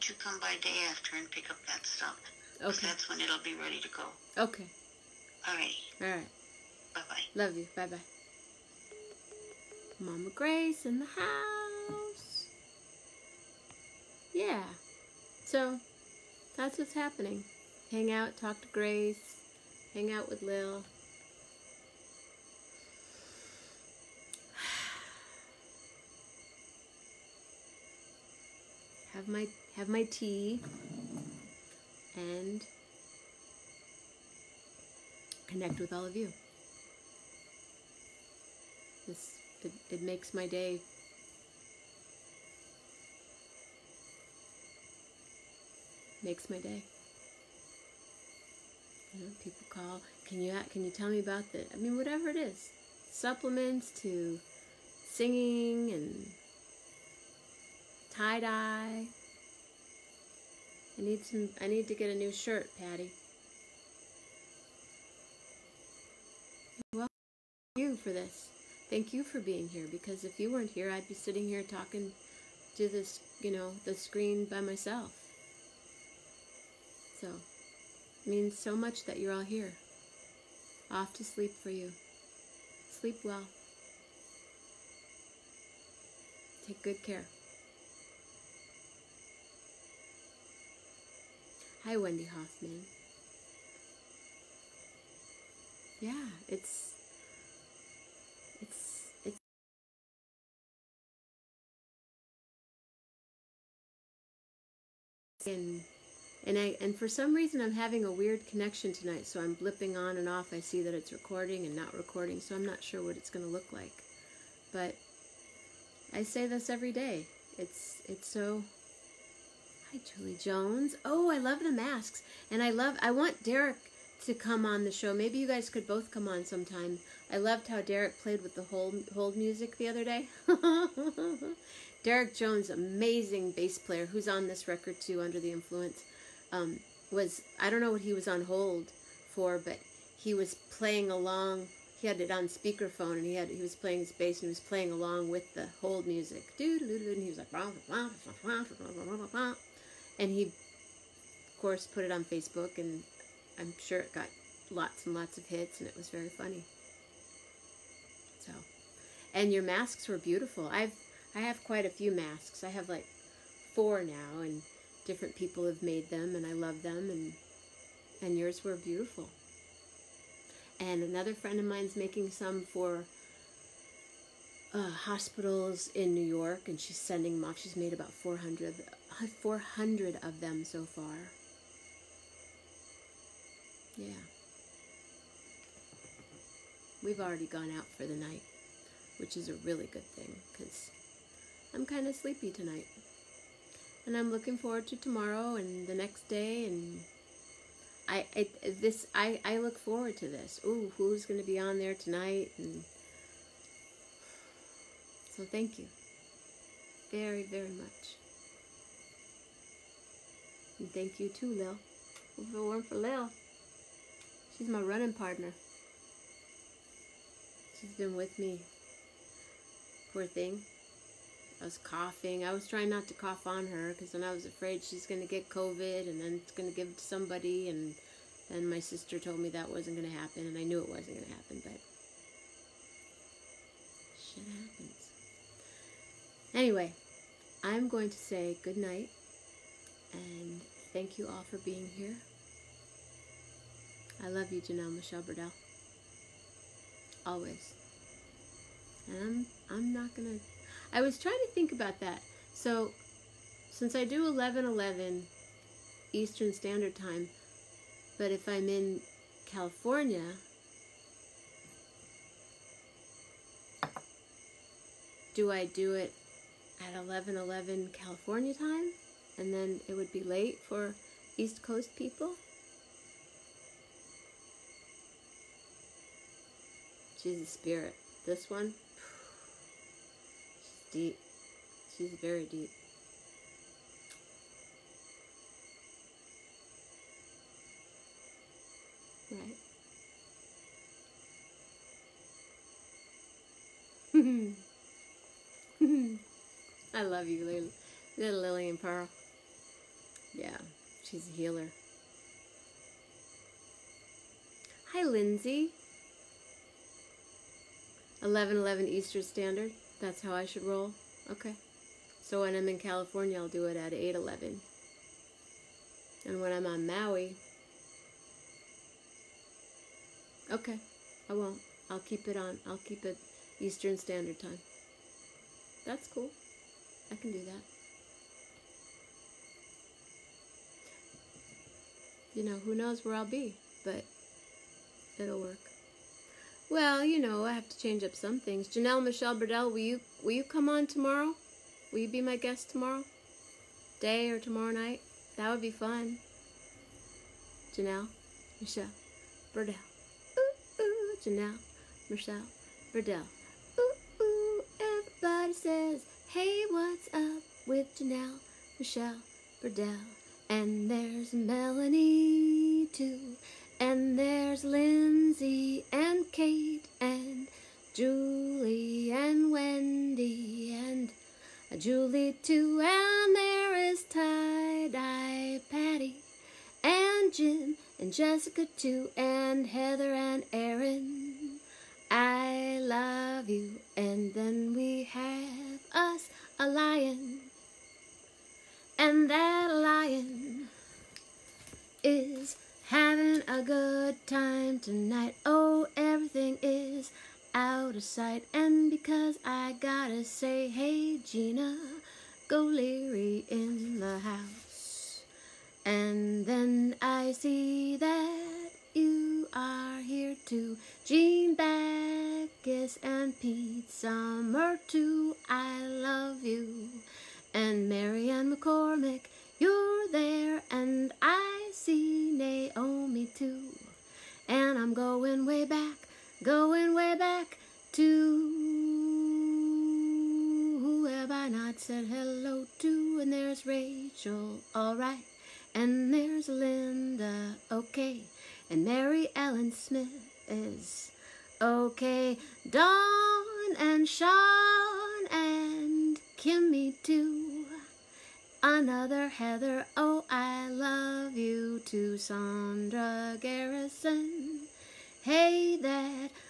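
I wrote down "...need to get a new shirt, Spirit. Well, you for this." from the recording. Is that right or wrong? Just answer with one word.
wrong.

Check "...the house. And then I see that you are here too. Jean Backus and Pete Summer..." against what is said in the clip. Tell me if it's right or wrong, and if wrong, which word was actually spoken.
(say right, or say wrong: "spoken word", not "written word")
right.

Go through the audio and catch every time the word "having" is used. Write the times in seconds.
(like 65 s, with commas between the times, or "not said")
107 s, 392 s.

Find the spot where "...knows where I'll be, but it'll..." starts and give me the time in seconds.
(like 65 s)
332 s.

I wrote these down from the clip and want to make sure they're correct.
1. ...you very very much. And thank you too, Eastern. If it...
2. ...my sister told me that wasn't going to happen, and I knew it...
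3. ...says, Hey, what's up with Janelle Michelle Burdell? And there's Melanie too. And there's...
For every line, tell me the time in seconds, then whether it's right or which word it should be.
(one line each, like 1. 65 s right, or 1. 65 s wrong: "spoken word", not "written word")
1. 205 s wrong: "Lil", not "Eastern"
2. 228 s right
3. 355 s right.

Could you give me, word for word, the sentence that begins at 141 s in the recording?
He had it on speakerphone, and he had he was playing his bass, and he was playing along with the hold music.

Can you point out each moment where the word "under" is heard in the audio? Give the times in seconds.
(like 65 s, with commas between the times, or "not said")
135 s.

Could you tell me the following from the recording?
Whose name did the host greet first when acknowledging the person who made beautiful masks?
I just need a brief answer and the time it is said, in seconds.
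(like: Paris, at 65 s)
Julie Jones, at 120 s.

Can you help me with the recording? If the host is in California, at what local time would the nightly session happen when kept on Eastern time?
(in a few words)
8:11.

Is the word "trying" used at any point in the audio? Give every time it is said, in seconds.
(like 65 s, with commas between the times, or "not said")
222 s, 251 s.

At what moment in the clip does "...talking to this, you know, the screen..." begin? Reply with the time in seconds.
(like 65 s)
71 s.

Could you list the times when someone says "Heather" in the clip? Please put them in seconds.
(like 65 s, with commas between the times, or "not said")
379 s, 449 s.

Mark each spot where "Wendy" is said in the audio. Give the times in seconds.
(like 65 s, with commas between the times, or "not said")
91 s, 369 s.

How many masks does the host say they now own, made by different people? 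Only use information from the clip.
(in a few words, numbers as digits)
4.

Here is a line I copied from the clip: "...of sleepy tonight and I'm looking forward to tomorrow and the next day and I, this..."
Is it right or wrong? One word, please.
right.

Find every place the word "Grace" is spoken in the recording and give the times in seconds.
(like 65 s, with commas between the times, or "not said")
10 s, 18 s.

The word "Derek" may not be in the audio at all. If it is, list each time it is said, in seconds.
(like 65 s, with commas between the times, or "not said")
123 s, 127 s, 132 s.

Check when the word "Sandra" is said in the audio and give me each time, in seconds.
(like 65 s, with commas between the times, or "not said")
452 s.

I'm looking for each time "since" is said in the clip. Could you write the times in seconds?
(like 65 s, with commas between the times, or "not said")
253 s.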